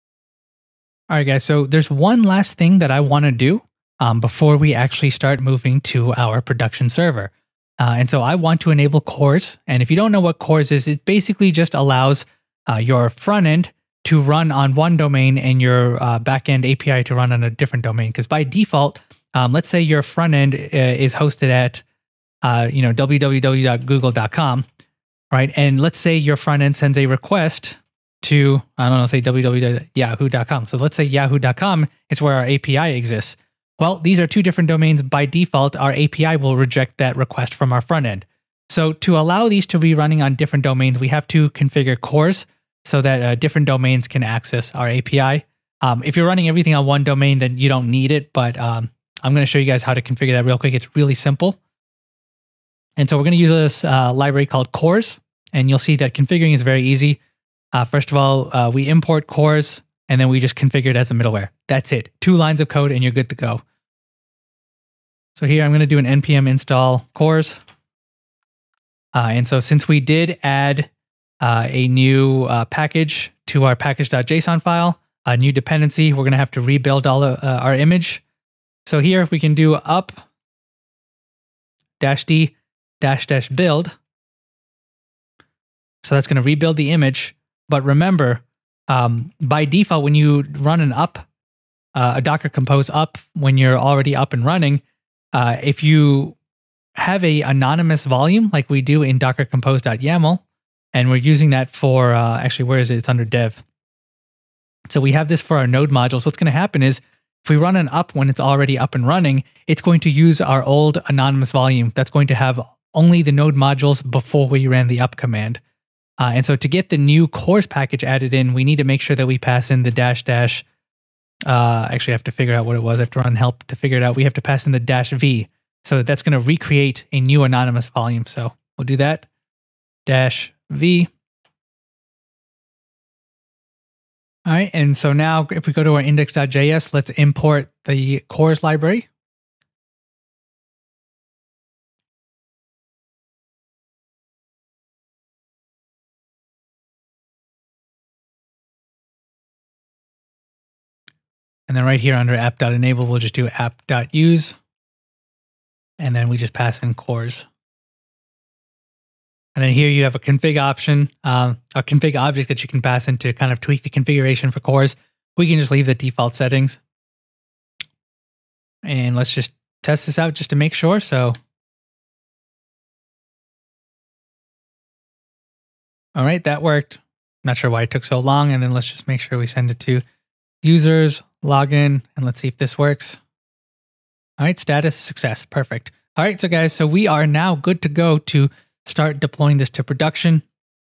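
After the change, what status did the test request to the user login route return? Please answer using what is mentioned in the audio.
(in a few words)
success.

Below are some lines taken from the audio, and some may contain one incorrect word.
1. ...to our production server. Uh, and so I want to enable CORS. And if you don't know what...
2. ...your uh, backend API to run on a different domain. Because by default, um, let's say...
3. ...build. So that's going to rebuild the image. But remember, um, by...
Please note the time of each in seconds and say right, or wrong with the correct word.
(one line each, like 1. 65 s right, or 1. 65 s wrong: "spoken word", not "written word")
1. 5 s right
2. 15 s right
3. 83 s right.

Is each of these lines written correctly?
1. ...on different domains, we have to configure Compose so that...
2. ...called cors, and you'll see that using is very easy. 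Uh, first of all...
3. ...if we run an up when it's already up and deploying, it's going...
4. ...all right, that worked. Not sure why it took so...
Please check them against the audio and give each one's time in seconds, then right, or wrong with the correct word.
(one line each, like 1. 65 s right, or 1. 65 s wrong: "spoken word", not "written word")
1. 40 s wrong: "CORS", not "Compose"
2. 54 s wrong: "configuring", not "using"
3. 107 s wrong: "running", not "deploying"
4. 176 s right.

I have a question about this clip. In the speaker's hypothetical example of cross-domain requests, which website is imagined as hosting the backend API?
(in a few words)
yahoo.com.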